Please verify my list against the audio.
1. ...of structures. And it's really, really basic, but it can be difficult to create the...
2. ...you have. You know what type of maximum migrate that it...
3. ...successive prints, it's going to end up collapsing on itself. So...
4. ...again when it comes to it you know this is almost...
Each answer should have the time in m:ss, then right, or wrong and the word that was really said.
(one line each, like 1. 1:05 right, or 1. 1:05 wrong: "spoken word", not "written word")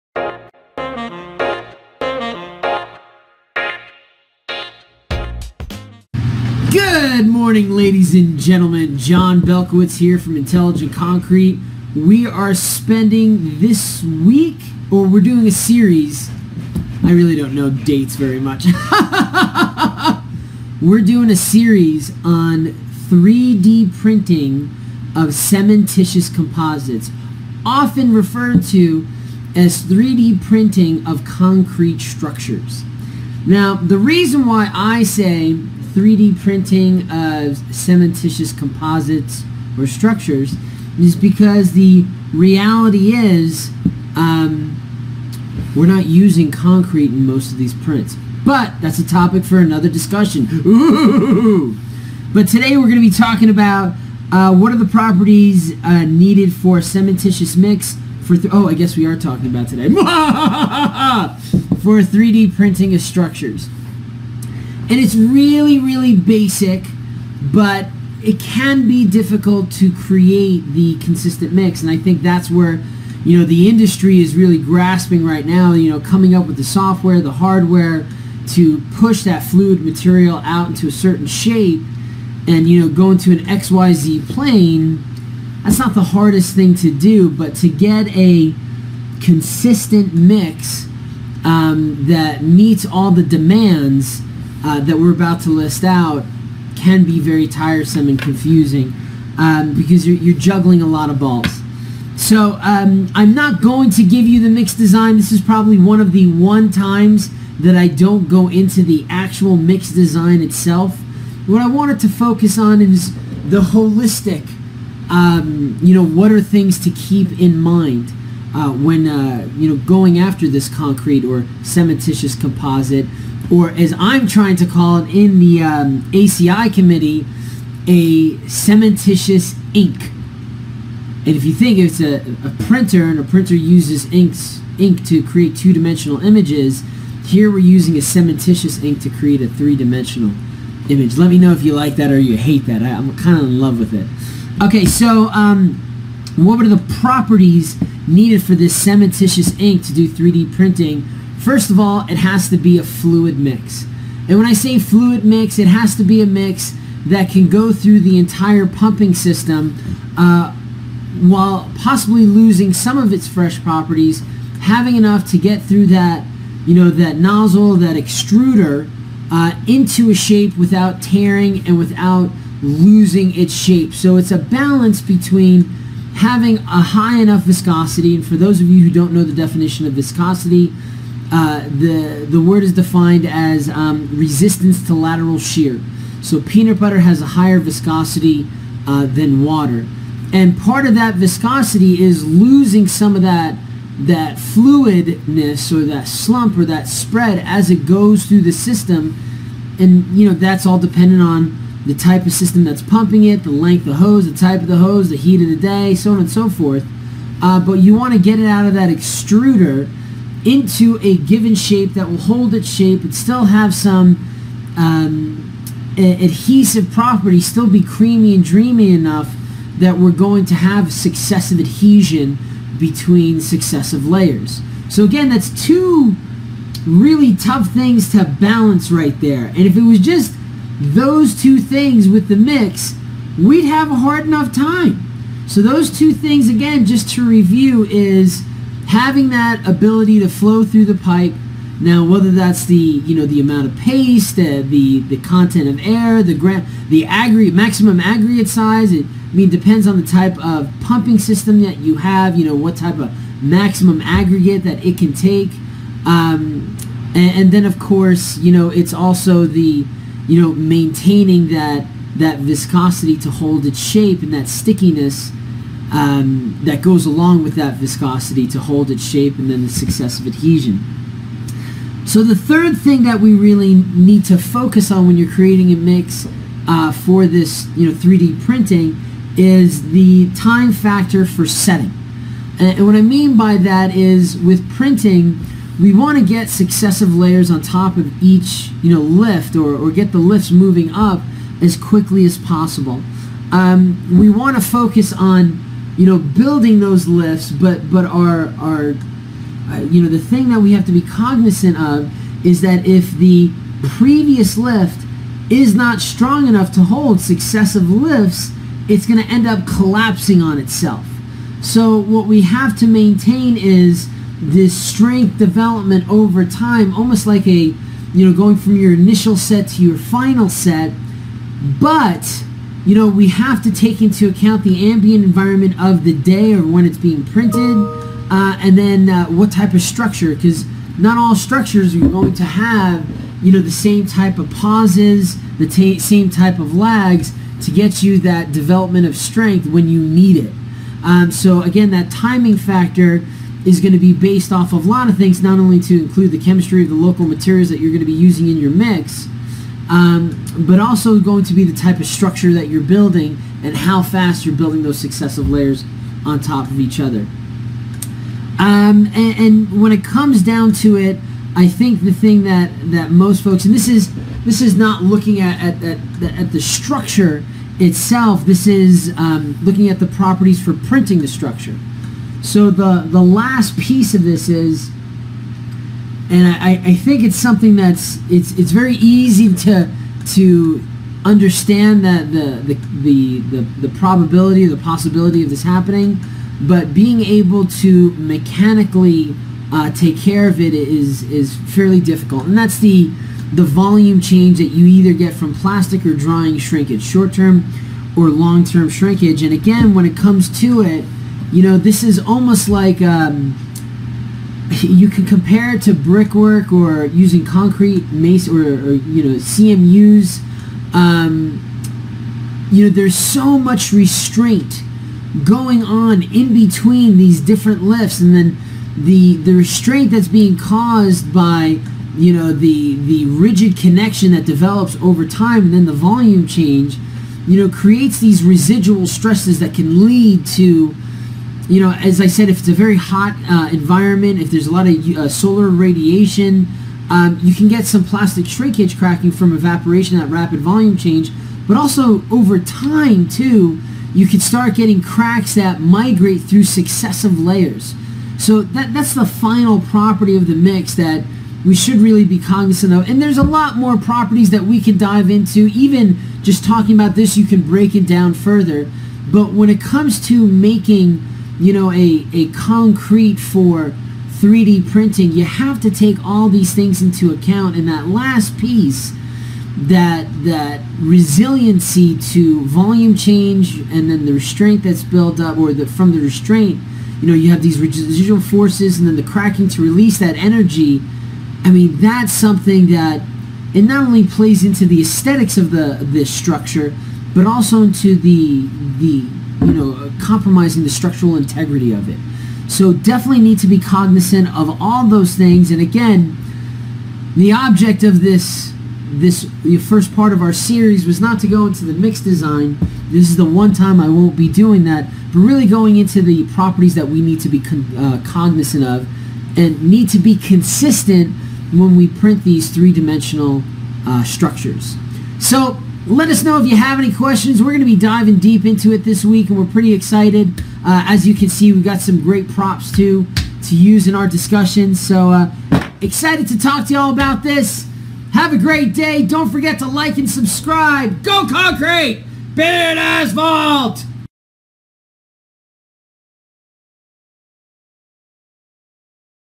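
1. 1:02 right
2. 4:11 wrong: "aggregate", not "migrate"
3. 5:07 wrong: "lifts", not "prints"
4. 6:39 right.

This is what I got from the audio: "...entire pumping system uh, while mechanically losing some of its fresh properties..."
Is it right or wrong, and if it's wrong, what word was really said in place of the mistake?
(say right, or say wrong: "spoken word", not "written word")
wrong: "possibly", not "mechanically".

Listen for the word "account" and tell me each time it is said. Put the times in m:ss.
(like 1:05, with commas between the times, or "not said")
5:24, 7:47.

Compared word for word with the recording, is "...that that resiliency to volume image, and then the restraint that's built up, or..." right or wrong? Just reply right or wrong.
wrong.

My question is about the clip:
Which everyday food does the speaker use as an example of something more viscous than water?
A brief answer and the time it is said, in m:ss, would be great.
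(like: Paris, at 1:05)
peanut butter, at 3:06.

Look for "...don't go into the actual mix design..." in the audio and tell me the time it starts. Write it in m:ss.
1:47.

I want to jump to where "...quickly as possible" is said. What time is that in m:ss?
4:51.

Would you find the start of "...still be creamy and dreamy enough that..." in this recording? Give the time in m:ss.
3:37.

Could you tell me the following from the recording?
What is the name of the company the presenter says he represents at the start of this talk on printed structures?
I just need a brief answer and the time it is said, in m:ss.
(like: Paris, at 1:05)
Intelligent Concrete, at 0:10.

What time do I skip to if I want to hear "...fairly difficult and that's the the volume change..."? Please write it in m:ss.
6:31.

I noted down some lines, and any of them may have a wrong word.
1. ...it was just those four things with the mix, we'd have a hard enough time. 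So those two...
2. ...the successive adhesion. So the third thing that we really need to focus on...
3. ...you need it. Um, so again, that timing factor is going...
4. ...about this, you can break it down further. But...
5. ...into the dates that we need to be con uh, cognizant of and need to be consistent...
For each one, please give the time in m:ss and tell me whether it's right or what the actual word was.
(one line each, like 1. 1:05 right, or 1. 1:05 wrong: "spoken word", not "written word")
1. 3:49 wrong: "two", not "four"
2. 4:29 right
3. 5:39 right
4. 7:36 right
5. 8:25 wrong: "properties", not "dates".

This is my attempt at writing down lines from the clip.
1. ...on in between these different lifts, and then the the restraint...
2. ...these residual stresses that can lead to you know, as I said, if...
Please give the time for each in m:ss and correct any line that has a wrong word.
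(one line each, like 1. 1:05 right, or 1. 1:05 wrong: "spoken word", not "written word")
1. 6:55 right
2. 7:08 right.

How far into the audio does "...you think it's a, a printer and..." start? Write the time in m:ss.
2:11.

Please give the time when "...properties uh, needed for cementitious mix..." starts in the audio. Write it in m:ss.
0:54.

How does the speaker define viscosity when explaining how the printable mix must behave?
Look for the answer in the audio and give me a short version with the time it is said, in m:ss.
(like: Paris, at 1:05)
resistance to lateral shear, at 3:04.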